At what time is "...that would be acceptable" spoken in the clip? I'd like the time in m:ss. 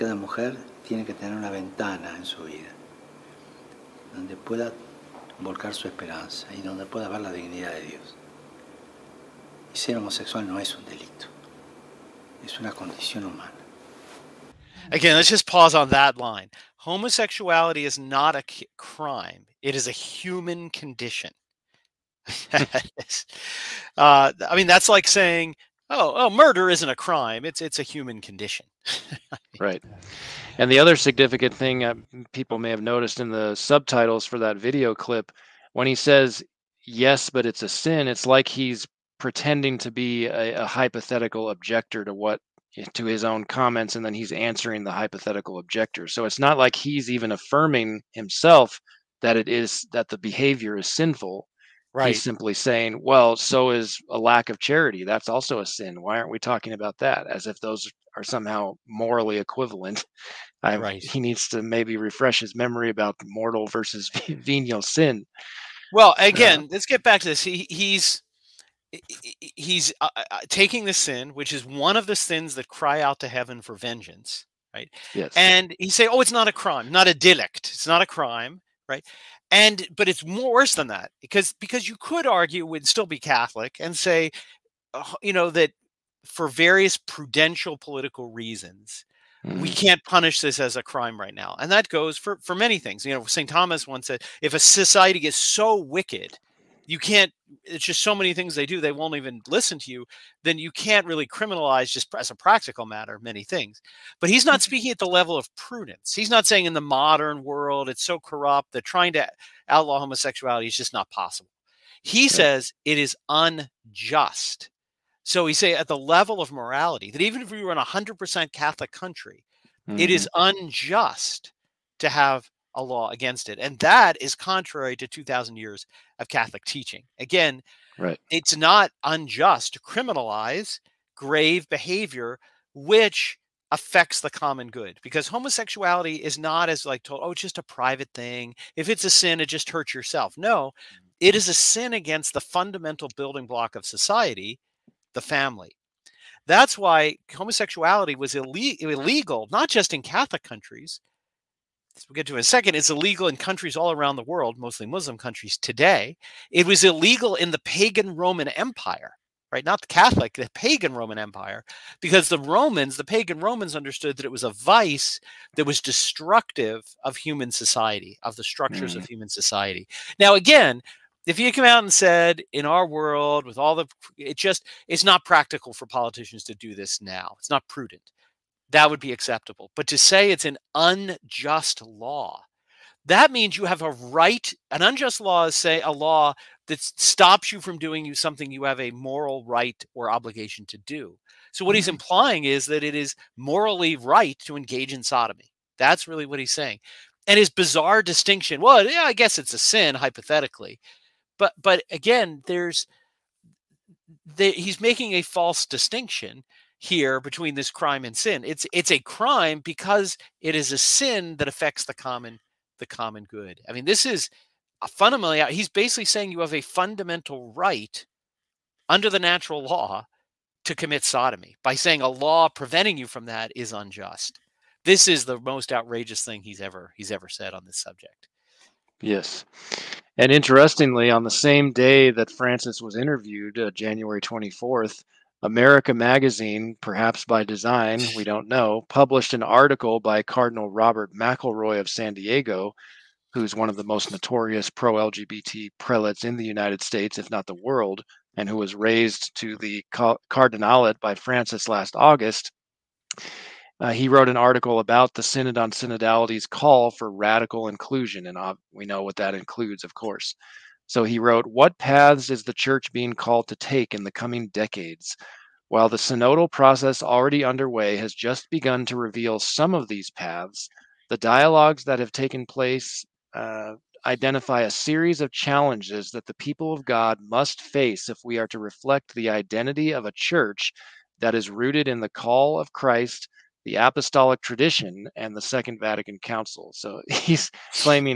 2:58.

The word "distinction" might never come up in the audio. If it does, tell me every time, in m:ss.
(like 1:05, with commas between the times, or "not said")
3:18, 3:25.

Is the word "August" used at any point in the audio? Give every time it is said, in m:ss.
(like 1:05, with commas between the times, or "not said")
4:11.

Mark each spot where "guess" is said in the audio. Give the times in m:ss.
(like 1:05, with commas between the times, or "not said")
3:19.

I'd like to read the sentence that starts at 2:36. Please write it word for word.
It was illegal in the pagan Roman Empire, right?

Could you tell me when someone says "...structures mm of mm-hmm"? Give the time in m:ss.
2:48.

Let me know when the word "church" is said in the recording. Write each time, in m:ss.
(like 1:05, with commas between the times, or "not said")
4:22, 4:40.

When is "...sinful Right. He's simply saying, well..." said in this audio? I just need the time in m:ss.
0:50.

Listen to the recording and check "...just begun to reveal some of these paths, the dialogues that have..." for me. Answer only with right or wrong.
right.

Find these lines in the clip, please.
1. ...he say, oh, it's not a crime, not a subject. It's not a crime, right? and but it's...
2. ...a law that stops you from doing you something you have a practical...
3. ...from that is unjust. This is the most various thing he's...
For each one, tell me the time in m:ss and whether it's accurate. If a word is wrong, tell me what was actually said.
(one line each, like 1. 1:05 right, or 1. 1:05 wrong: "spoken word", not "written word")
1. 1:15 wrong: "delict", not "subject"
2. 3:05 wrong: "moral", not "practical"
3. 3:43 wrong: "outrageous", not "various".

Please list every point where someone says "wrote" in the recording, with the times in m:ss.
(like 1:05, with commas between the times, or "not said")
4:14, 4:21.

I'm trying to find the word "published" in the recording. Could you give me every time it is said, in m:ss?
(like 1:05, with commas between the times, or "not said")
3:58.